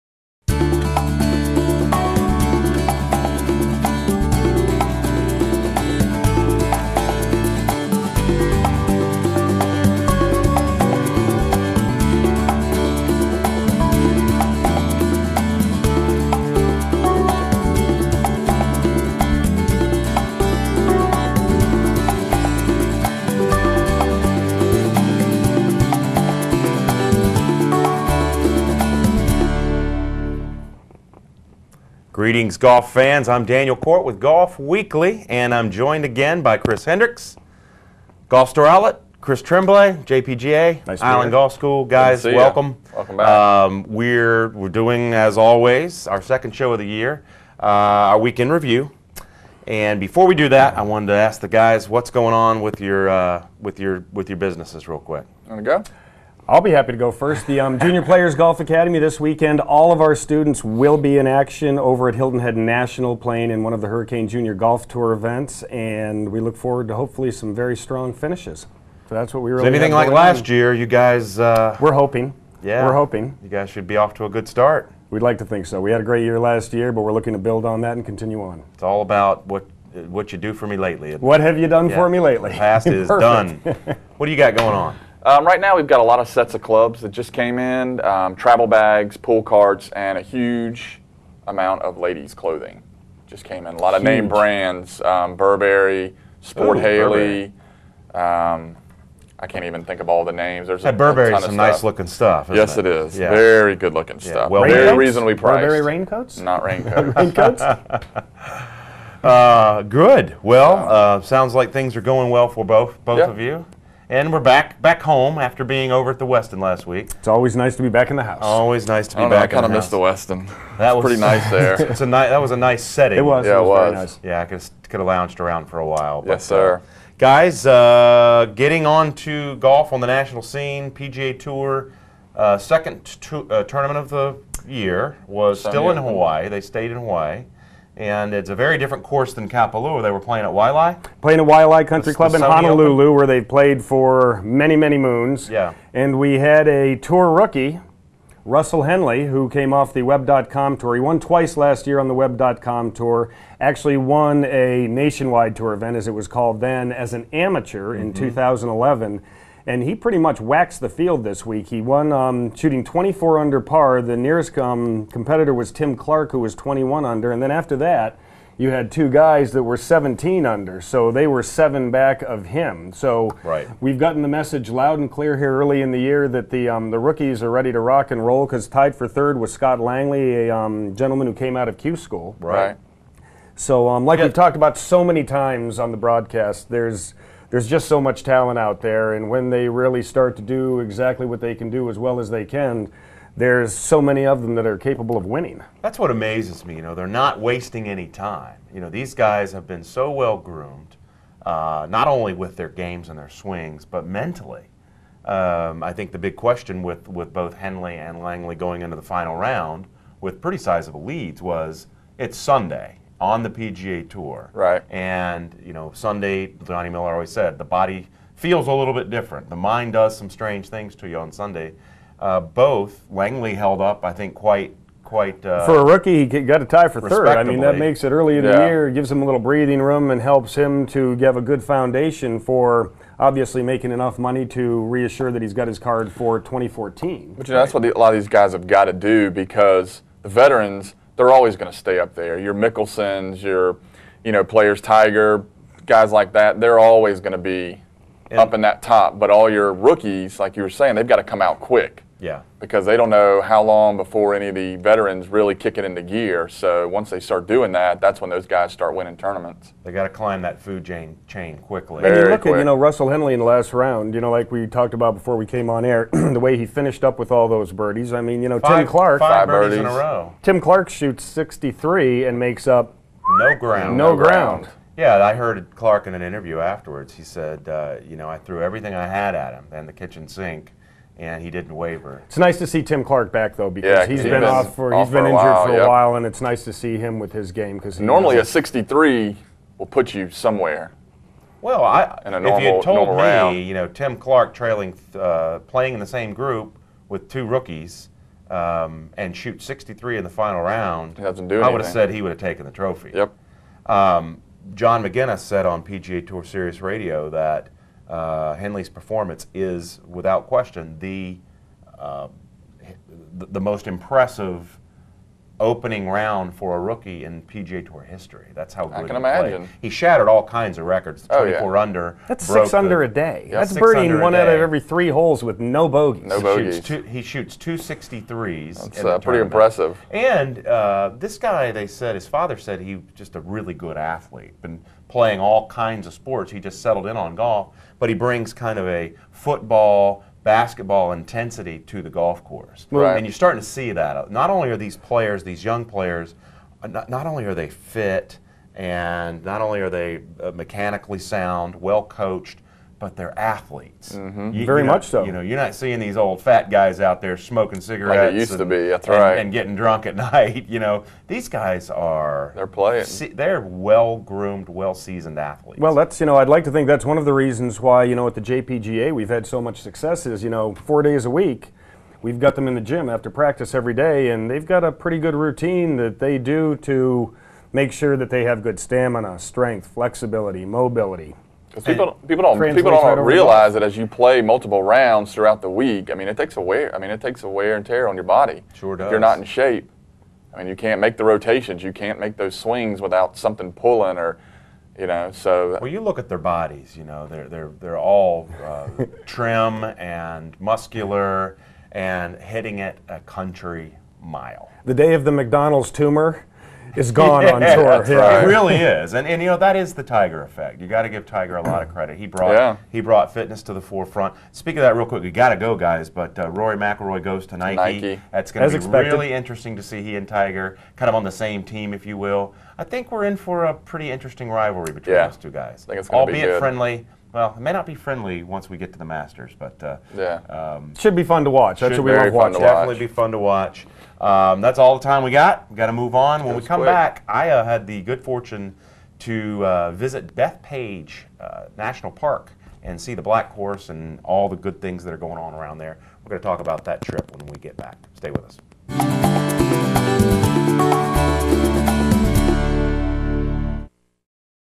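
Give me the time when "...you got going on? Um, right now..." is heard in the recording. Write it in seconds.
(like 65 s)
84 s.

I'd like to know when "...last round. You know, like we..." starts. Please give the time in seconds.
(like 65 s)
263 s.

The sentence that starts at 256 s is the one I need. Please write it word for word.
So once they start doing that, that's when those guys start winning tournaments.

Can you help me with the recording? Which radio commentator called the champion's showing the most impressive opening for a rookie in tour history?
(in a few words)
John Maginnes.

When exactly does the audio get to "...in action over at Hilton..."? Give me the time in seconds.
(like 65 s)
61 s.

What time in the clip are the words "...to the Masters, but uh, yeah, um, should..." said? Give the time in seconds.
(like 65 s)
428 s.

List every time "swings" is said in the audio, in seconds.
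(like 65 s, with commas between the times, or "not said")
203 s, 392 s.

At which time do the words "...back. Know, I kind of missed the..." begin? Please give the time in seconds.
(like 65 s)
119 s.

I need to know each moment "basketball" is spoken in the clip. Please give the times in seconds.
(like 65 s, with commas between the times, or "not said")
340 s.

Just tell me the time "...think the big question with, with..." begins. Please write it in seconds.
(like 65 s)
205 s.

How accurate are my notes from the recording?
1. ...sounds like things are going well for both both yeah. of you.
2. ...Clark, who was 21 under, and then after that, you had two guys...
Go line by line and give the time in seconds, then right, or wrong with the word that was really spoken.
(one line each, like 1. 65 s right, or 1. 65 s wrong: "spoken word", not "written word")
1. 111 s right
2. 165 s right.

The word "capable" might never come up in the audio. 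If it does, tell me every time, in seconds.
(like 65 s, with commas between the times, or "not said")
194 s.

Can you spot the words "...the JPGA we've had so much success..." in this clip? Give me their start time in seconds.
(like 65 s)
368 s.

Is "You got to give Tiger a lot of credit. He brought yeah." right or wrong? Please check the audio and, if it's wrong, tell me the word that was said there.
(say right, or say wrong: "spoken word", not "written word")
right.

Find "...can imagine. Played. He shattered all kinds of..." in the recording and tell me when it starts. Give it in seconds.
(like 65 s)
319 s.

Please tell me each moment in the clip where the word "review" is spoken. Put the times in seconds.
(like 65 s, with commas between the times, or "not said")
48 s.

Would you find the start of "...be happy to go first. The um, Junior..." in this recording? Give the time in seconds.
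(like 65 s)
56 s.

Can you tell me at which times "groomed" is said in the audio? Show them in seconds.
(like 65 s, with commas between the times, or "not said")
200 s, 364 s.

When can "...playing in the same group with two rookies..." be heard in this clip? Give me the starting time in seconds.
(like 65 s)
295 s.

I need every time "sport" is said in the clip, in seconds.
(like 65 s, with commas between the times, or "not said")
96 s, 336 s.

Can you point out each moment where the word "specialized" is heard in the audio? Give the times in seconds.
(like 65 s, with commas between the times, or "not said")
not said.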